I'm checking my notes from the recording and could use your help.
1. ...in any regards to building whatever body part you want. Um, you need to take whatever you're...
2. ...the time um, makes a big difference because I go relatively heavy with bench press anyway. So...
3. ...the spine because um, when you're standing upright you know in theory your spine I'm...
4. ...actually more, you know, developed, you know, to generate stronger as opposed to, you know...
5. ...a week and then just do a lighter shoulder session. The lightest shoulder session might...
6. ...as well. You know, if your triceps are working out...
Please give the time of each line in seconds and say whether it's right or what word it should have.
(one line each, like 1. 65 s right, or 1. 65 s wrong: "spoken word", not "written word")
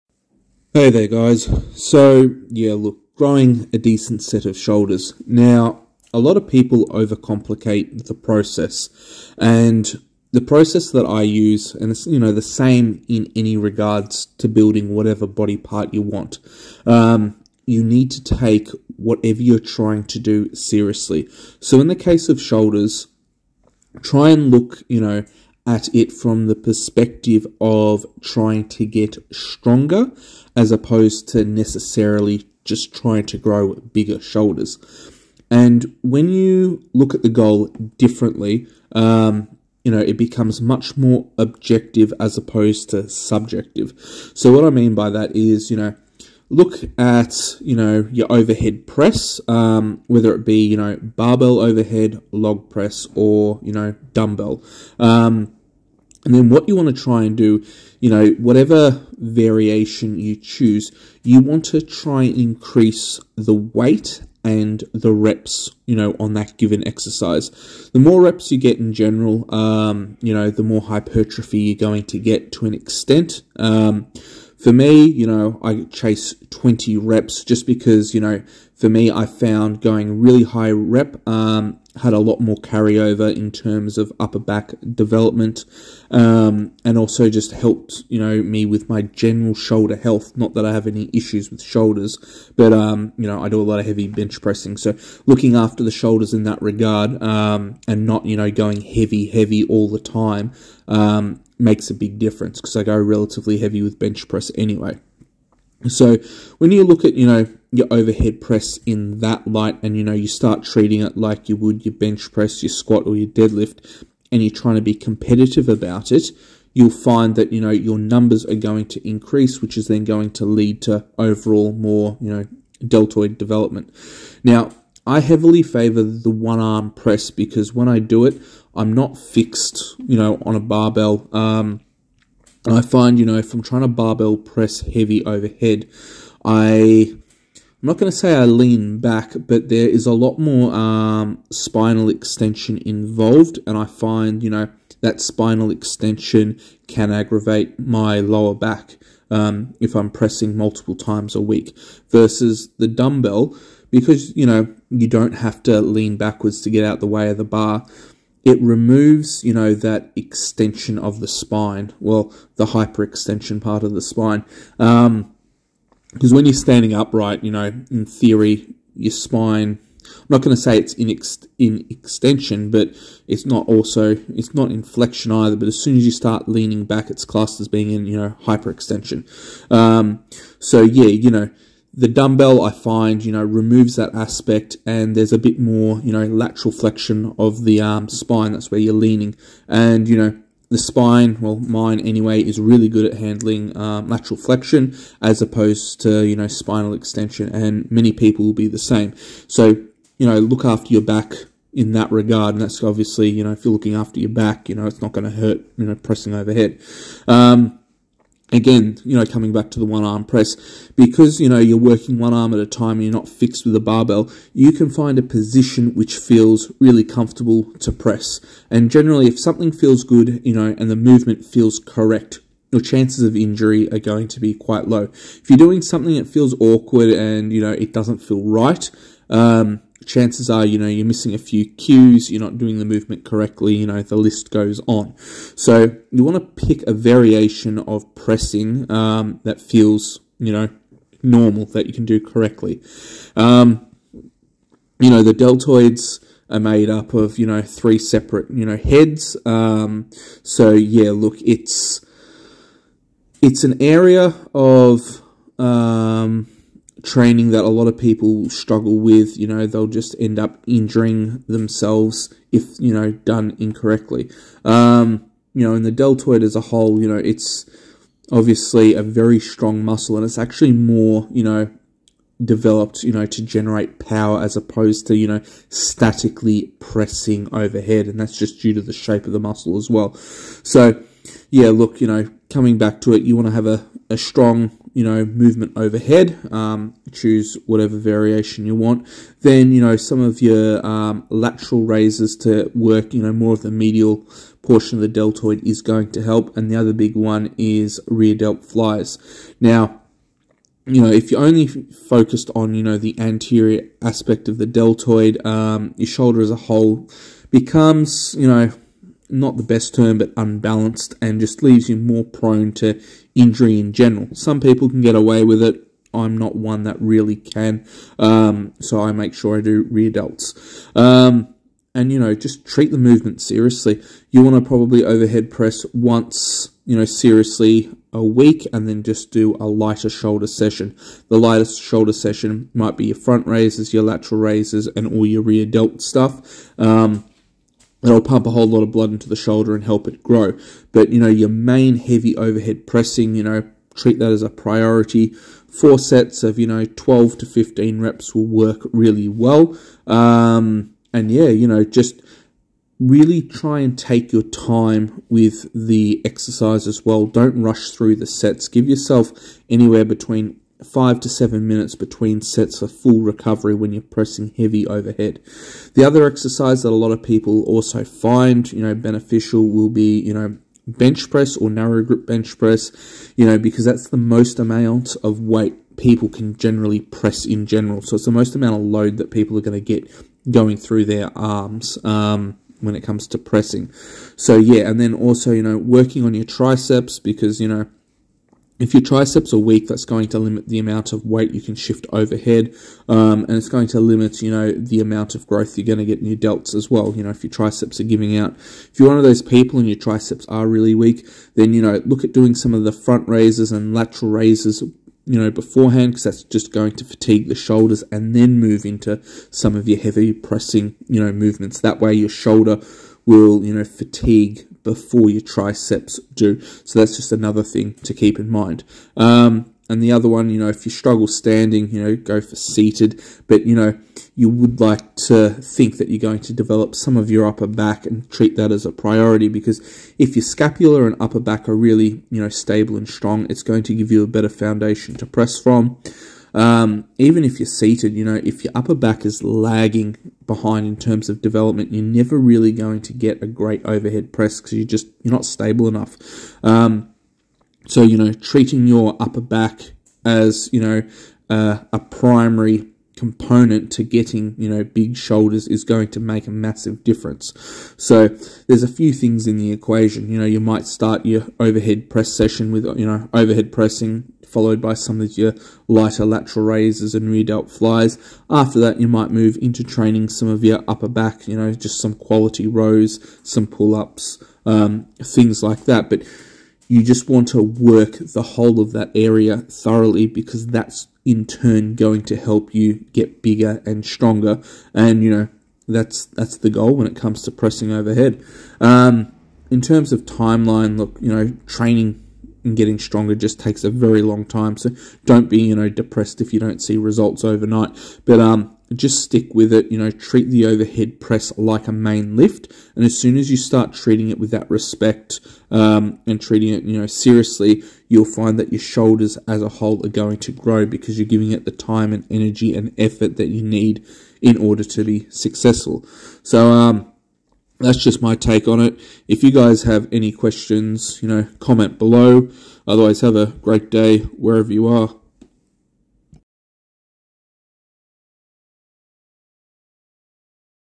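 1. 13 s right
2. 99 s right
3. 163 s right
4. 270 s wrong: "power", not "stronger"
5. 328 s right
6. 396 s wrong: "giving", not "working".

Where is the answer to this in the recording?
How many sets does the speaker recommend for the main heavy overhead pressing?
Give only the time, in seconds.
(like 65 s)
345 s.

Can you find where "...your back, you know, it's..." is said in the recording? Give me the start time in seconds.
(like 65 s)
204 s.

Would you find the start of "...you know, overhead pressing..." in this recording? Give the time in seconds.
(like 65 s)
462 s.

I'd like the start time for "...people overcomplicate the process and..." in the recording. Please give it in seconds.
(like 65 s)
6 s.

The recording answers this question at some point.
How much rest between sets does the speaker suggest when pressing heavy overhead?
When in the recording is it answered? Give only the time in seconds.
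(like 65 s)
360 s.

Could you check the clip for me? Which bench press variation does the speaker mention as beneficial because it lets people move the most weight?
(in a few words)
Narrow grip bench press.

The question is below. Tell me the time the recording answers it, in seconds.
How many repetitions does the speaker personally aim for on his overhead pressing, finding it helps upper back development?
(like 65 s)
76 s.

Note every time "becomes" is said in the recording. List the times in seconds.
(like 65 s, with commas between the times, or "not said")
40 s, 307 s.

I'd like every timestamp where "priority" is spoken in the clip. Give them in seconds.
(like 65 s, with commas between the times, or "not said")
344 s, 428 s.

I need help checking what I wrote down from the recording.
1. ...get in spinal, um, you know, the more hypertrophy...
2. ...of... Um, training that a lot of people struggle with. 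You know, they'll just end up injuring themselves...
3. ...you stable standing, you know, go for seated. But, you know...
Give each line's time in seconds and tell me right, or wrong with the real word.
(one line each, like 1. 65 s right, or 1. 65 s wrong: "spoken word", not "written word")
1. 68 s wrong: "general", not "spinal"
2. 254 s right
3. 420 s wrong: "struggle", not "stable".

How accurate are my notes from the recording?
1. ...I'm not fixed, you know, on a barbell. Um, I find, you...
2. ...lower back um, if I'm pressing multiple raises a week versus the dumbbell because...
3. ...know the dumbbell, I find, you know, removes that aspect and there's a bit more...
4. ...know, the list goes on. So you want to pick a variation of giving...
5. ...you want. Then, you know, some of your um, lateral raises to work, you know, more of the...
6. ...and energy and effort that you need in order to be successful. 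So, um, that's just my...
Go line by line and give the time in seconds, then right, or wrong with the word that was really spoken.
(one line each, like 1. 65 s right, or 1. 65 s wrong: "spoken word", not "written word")
1. 128 s right
2. 148 s wrong: "times", not "raises"
3. 181 s right
4. 233 s wrong: "pressing", not "giving"
5. 288 s right
6. 512 s right.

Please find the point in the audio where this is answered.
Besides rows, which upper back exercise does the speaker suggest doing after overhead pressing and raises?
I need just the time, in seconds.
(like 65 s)
473 s.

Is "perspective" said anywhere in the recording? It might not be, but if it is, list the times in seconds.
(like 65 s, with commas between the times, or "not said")
26 s.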